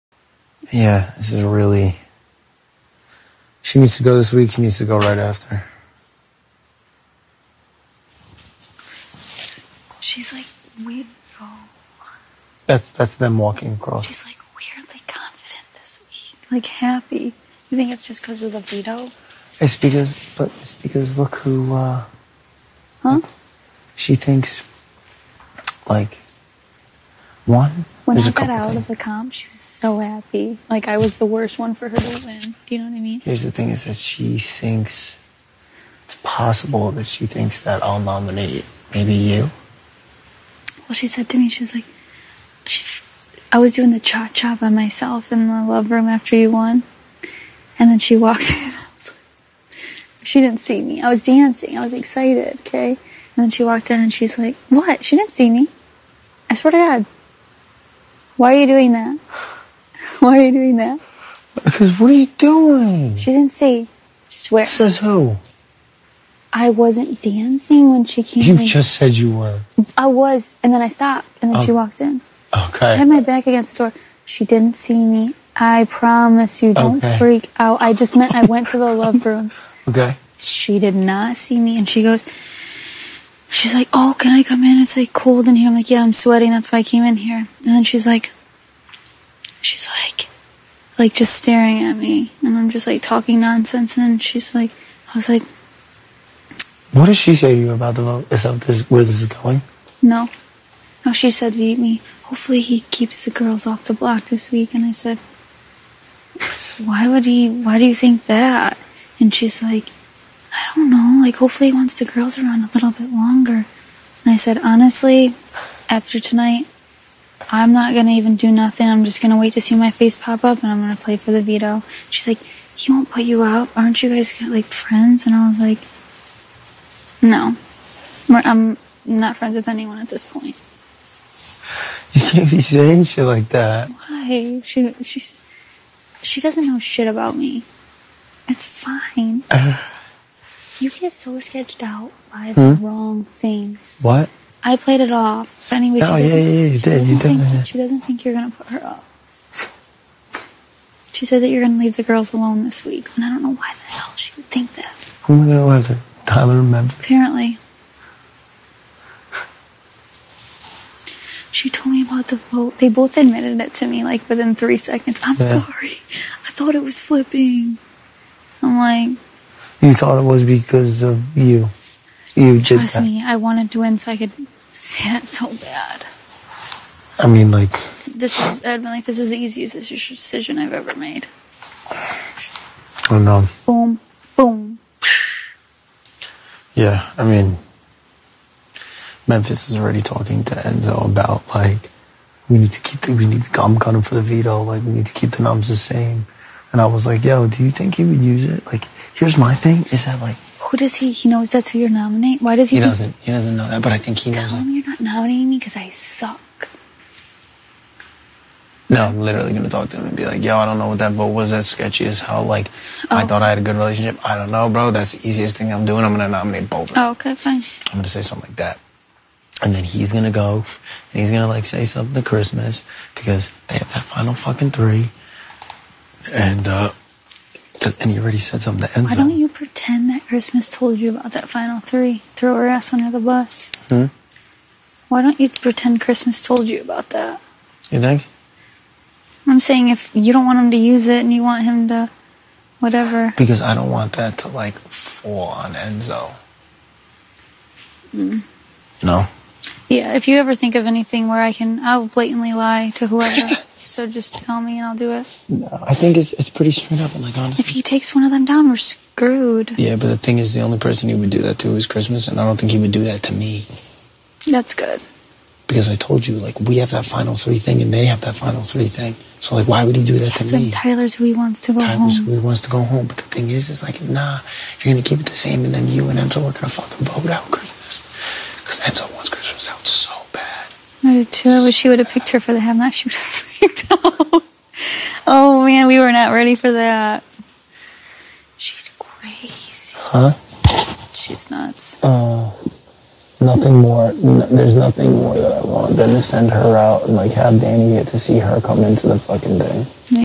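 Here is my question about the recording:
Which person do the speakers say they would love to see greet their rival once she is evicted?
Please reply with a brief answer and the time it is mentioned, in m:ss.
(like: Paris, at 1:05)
Dani, at 4:57.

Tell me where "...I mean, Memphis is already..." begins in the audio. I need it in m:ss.
3:07.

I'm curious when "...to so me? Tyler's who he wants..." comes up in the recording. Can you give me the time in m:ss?
4:30.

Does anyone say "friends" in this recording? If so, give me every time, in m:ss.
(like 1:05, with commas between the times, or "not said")
2:04, 2:09.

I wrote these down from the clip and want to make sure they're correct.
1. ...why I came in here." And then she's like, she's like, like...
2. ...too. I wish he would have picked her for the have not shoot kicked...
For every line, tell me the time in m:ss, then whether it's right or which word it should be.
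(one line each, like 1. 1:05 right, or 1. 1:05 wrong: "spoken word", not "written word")
1. 1:26 right
2. 4:41 right.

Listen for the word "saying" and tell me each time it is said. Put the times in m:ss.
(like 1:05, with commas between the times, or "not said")
2:12, 3:59.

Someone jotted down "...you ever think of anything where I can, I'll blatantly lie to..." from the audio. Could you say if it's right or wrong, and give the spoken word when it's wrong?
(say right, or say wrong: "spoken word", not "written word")
right.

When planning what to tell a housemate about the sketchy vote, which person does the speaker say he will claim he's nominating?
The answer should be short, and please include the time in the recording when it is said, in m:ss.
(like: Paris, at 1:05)
Bolden, at 3:36.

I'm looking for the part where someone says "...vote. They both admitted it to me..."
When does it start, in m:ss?
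2:42.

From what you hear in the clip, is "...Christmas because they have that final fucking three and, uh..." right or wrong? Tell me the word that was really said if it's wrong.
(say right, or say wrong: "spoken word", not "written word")
right.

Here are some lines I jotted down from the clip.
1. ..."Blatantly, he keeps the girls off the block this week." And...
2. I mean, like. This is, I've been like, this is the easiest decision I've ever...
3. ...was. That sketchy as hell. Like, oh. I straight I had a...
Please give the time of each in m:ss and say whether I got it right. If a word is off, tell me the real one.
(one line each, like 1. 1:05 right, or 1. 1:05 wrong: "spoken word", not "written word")
1. 1:42 wrong: "Hopefully", not "Blatantly"
2. 2:57 right
3. 3:31 wrong: "thought", not "straight".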